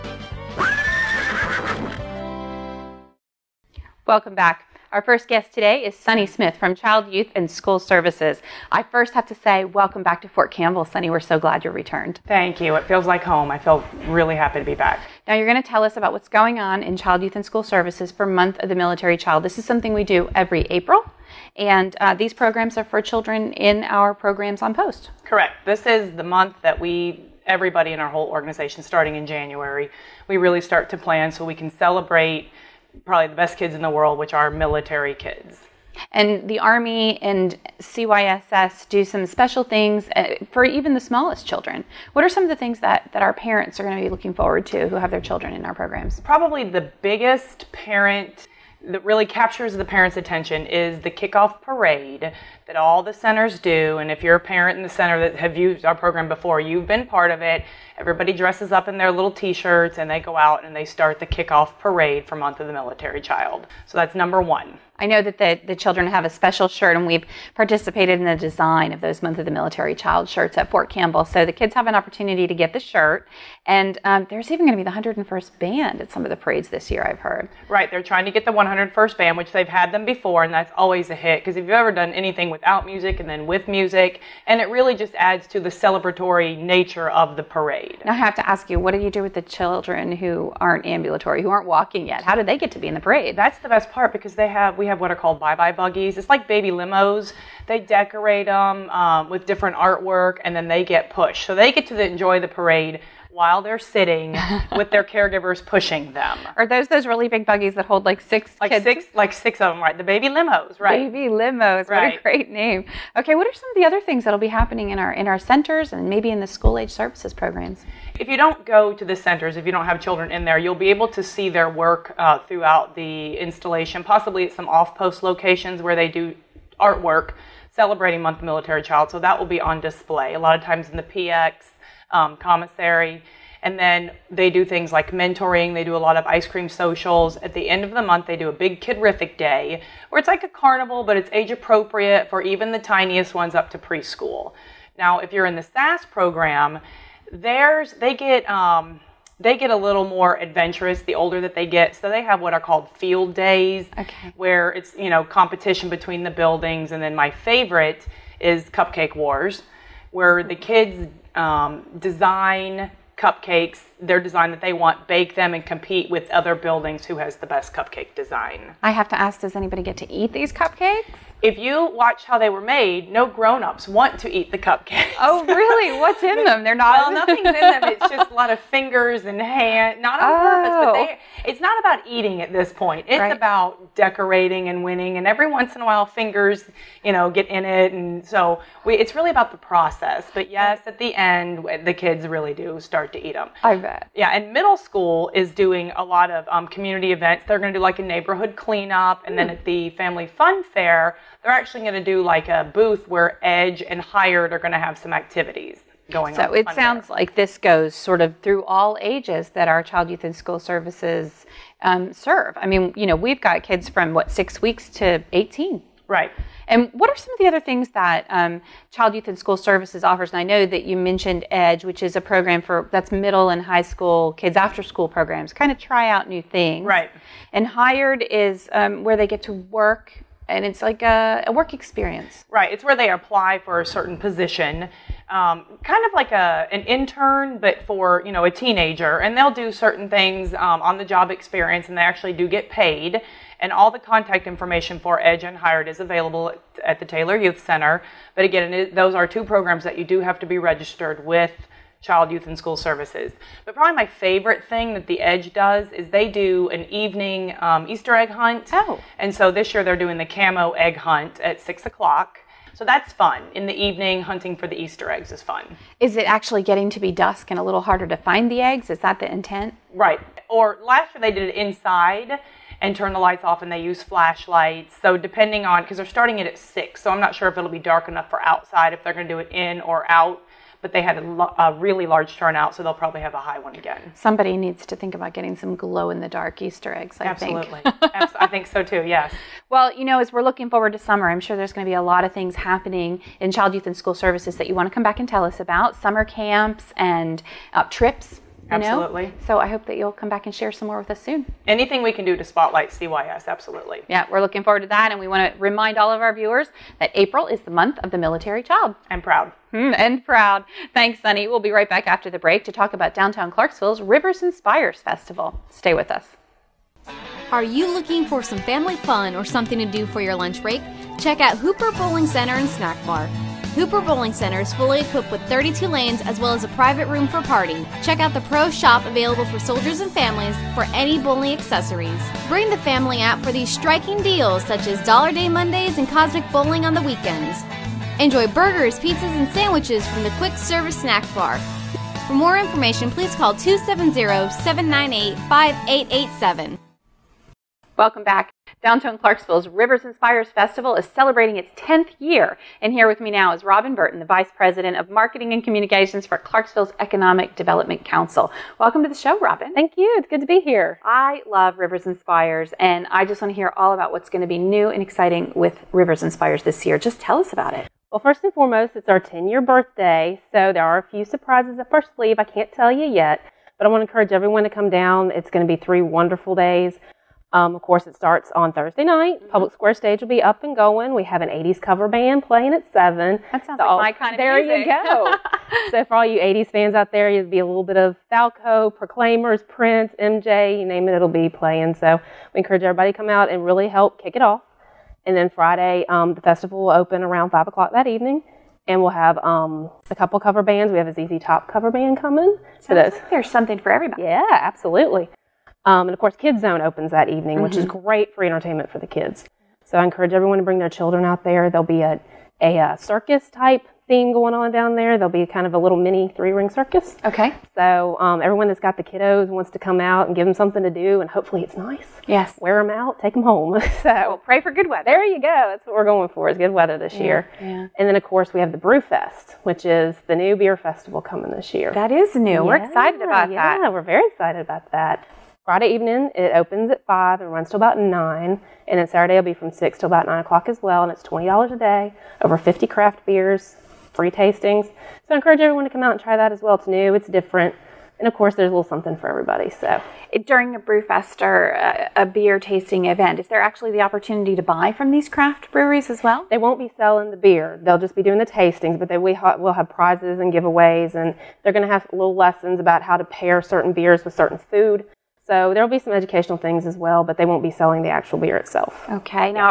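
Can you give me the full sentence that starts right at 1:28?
Now, I have to ask you, what do you do with the children who aren't ambulatory, who aren't walking yet?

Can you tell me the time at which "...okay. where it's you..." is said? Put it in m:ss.
2:33.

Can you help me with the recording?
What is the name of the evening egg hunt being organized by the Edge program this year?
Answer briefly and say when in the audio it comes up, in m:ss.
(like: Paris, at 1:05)
Camo egg hunt, at 4:20.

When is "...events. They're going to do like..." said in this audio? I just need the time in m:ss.
3:17.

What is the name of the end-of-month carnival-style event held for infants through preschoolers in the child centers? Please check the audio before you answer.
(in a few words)
Kidrific Day.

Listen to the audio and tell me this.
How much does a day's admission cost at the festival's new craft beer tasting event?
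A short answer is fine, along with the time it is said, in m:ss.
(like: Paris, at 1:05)
$20, at 7:21.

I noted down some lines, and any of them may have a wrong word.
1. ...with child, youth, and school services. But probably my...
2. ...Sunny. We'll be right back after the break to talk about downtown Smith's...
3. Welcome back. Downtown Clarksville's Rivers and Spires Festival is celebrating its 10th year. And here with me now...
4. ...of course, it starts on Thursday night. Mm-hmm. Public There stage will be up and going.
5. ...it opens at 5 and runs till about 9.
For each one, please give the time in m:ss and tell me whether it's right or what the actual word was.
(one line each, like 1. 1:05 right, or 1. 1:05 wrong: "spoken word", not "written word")
1. 4:11 right
2. 5:11 wrong: "Clarksville", not "Smith"
3. 5:47 right
4. 6:17 wrong: "Square", not "There"
5. 7:16 right.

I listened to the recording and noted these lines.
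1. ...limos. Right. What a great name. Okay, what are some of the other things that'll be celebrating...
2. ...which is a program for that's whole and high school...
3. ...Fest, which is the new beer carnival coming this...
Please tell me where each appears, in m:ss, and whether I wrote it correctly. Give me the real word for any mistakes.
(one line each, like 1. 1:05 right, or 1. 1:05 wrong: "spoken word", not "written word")
1. 1:51 wrong: "happening", not "celebrating"
2. 3:41 wrong: "middle", not "whole"
3. 7:09 wrong: "festival", not "carnival".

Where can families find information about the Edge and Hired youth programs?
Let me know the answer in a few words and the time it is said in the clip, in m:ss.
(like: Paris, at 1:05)
Taylor Youth Center, at 4:07.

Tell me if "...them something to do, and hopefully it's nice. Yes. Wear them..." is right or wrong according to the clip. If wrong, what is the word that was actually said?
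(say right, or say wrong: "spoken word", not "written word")
right.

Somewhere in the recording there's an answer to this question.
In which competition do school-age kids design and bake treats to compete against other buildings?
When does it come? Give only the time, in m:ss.
2:38.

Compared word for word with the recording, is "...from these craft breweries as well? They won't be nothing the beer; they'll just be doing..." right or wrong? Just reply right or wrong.
wrong.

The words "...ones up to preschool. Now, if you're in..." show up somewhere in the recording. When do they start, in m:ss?
2:23.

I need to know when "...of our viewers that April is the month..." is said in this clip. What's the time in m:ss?
5:06.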